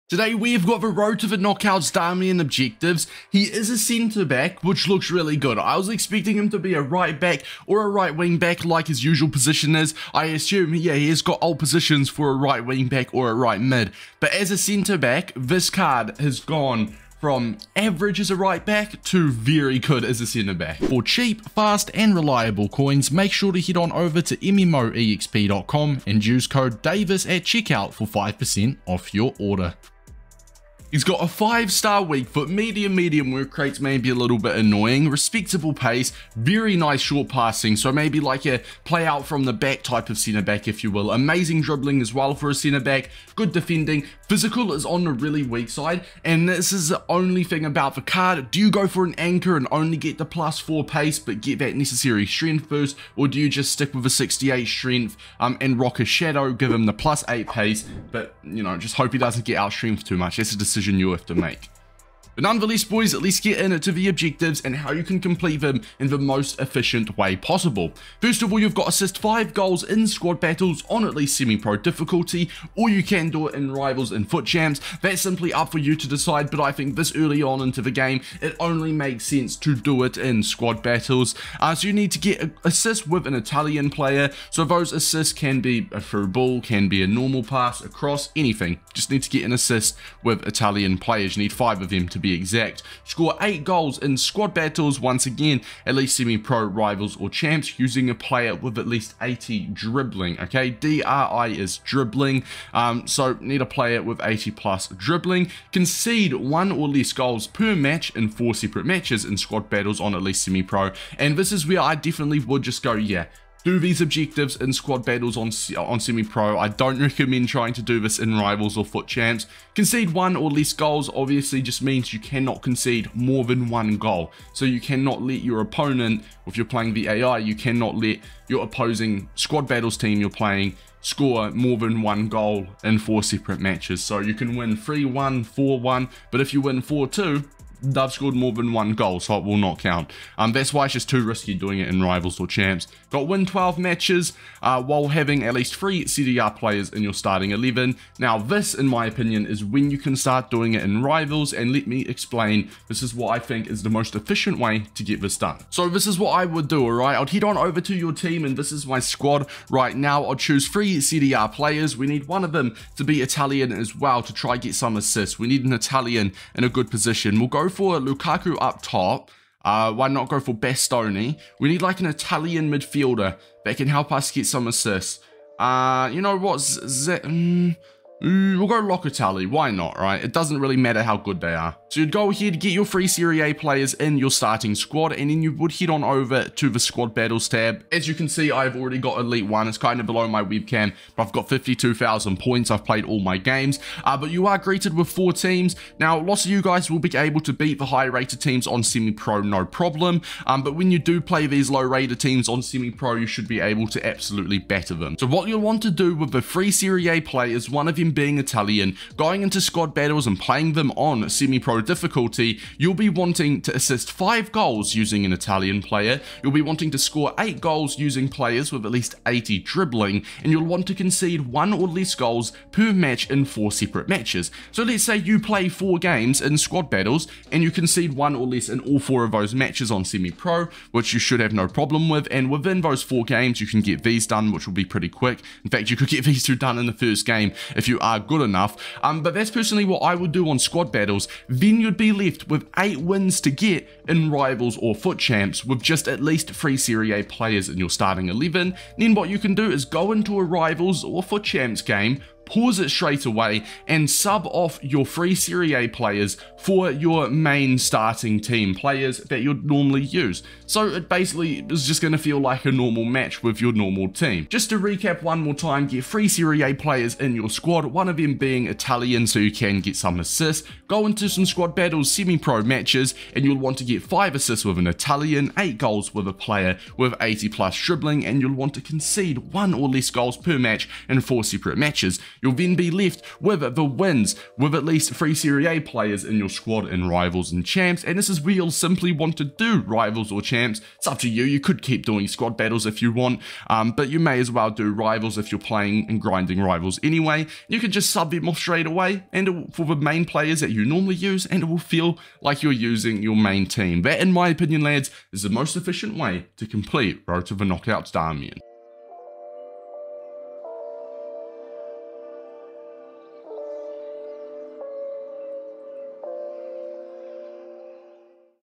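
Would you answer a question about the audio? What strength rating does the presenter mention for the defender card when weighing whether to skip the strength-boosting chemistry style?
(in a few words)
68.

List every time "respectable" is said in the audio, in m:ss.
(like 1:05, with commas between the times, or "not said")
0:35.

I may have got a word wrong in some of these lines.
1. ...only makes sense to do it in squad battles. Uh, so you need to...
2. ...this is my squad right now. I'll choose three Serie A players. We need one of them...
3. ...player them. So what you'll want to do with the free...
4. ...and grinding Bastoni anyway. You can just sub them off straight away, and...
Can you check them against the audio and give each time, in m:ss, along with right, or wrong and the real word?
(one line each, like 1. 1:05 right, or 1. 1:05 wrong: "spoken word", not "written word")
1. 1:18 right
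2. 2:38 right
3. 3:24 wrong: "better", not "player"
4. 4:56 wrong: "Rivals", not "Bastoni".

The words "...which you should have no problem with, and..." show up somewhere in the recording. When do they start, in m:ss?
3:50.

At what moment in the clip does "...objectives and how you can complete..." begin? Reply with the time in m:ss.
1:04.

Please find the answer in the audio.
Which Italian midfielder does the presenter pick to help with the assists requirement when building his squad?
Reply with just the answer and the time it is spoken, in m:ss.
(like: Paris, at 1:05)
Locatelli, at 2:58.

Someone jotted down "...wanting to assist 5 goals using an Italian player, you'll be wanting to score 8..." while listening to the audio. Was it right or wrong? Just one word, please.
right.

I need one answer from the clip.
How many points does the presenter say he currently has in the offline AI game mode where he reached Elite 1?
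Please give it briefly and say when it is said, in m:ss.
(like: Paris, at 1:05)
52,000, at 3:11.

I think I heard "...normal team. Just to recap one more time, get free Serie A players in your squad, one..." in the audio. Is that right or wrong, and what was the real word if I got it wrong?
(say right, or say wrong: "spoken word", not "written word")
right.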